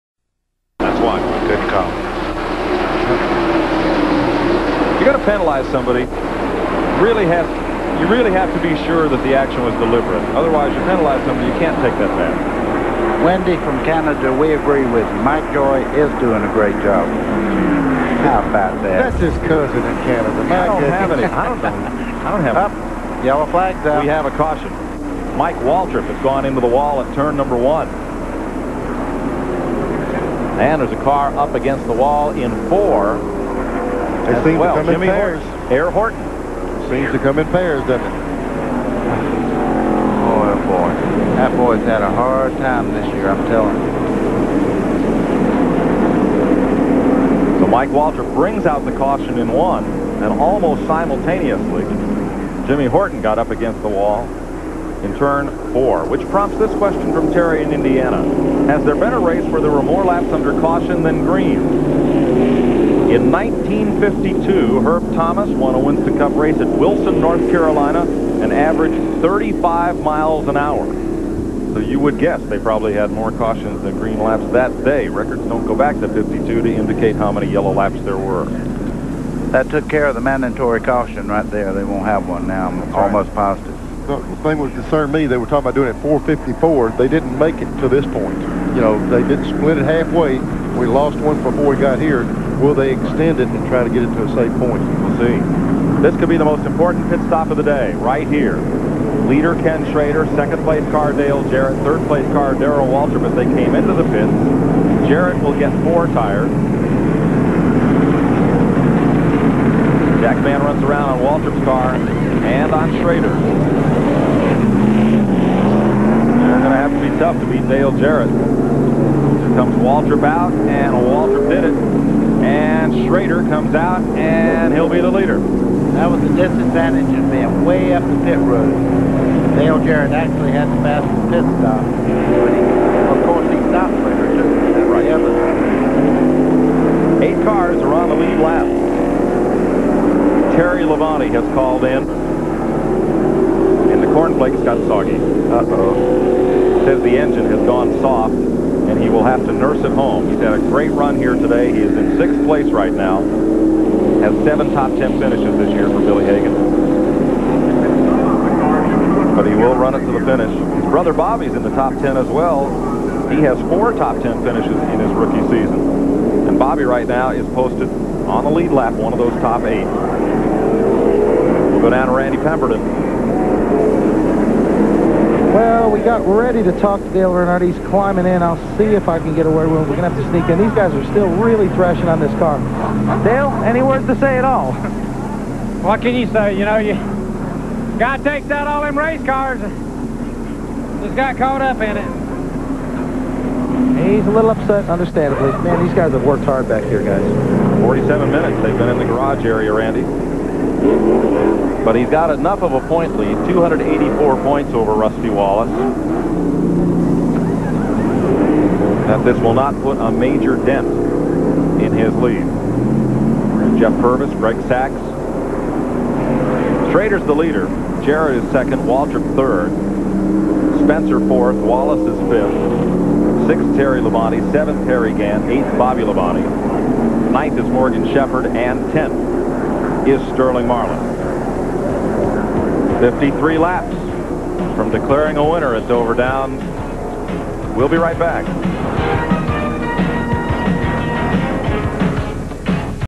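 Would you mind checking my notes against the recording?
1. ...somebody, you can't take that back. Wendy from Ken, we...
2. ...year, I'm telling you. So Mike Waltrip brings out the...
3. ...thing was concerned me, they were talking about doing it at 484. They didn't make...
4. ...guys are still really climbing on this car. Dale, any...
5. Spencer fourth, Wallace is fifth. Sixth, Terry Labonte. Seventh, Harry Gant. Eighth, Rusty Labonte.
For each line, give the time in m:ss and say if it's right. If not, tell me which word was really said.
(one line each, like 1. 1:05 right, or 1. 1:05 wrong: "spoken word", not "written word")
1. 0:11 wrong: "Canada", not "Ken"
2. 0:43 right
3. 1:24 wrong: "454", not "484"
4. 3:00 wrong: "thrashing", not "climbing"
5. 3:40 wrong: "Bobby", not "Rusty".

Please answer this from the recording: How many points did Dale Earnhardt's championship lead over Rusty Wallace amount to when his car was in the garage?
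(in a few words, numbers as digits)
284.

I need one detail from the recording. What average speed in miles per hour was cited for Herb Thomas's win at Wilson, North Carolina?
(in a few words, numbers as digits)
35.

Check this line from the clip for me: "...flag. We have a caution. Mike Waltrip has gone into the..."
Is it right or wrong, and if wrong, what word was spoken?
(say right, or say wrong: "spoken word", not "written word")
right.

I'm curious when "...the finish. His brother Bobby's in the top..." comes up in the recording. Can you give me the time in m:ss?
2:40.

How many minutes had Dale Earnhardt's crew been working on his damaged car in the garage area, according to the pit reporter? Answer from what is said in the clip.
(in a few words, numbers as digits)
47.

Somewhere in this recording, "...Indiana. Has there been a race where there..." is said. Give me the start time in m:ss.
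0:57.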